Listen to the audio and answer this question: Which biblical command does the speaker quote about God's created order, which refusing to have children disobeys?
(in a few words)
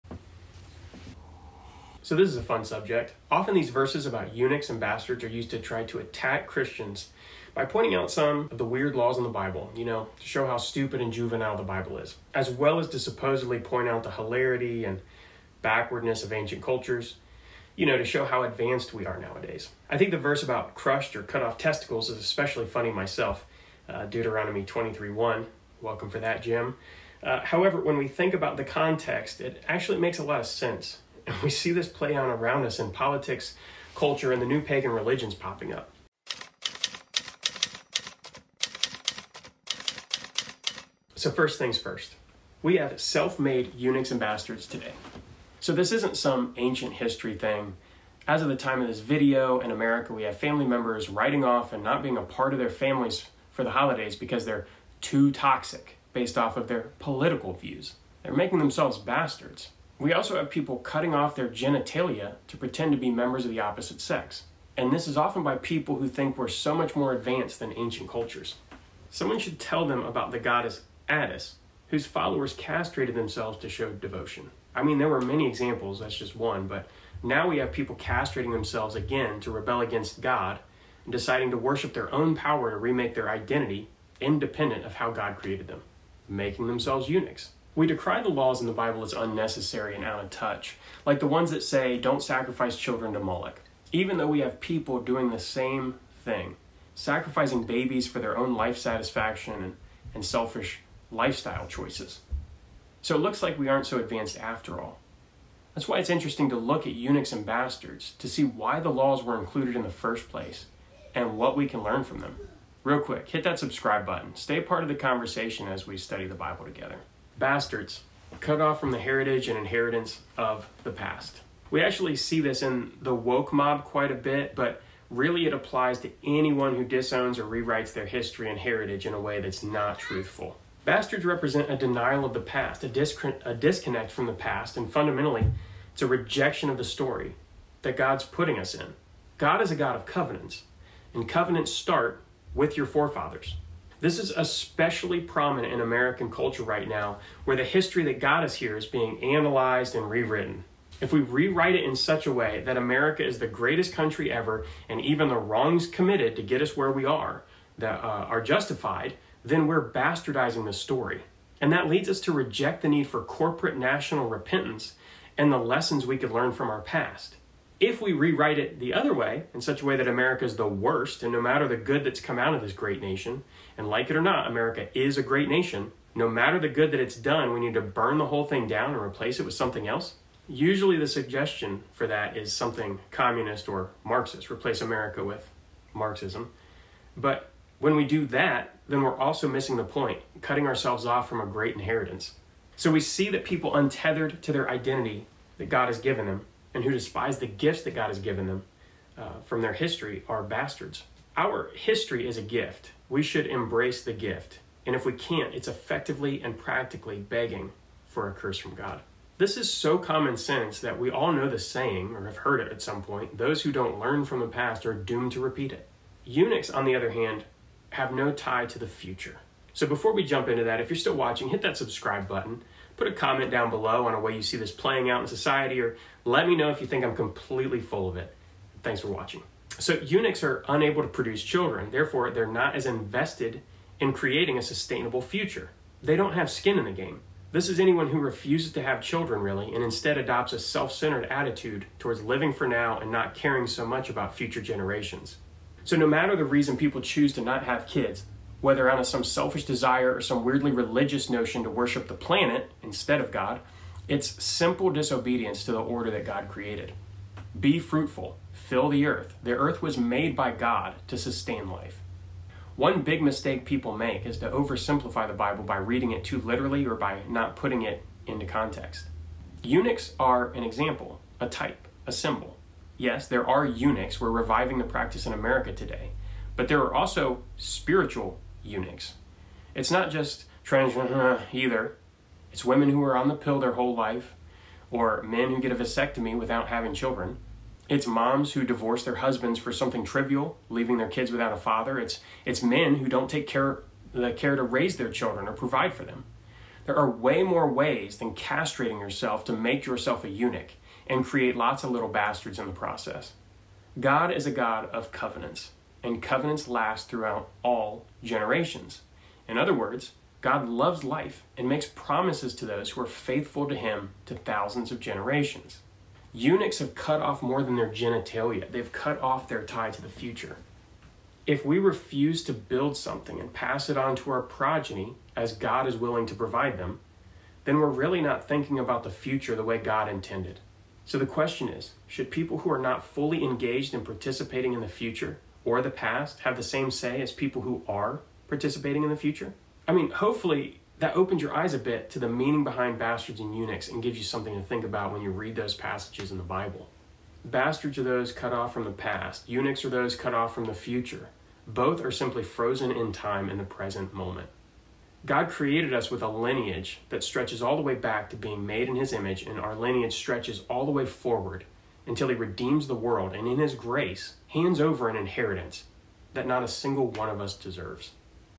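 Be fruitful, fill the earth.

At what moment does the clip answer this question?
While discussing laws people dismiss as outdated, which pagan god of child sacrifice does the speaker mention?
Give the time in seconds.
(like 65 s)
93 s.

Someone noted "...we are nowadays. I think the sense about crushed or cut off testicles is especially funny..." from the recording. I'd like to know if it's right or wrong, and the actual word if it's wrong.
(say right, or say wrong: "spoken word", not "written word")
wrong: "verse", not "sense".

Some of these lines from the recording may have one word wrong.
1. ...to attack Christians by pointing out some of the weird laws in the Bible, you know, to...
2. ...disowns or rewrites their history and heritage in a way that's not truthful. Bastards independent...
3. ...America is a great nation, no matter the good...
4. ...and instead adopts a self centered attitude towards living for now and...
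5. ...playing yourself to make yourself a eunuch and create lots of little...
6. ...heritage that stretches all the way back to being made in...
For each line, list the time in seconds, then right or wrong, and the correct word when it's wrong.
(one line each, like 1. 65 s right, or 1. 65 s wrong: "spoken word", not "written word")
1. 5 s right
2. 126 s wrong: "represent", not "independent"
3. 174 s right
4. 239 s right
5. 298 s wrong: "castrating", not "playing"
6. 356 s wrong: "lineage", not "heritage".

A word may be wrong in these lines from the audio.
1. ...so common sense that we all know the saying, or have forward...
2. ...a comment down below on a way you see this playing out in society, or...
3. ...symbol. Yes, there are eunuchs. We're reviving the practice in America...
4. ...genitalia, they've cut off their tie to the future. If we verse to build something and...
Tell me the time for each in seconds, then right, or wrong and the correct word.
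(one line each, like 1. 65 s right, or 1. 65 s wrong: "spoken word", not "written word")
1. 209 s wrong: "heard", not "forward"
2. 223 s right
3. 272 s right
4. 317 s wrong: "refuse", not "verse".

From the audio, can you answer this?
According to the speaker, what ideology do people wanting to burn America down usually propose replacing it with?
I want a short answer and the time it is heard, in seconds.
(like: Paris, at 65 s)
Marxism, at 185 s.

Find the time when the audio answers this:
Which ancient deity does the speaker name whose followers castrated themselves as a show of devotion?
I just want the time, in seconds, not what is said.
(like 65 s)
71 s.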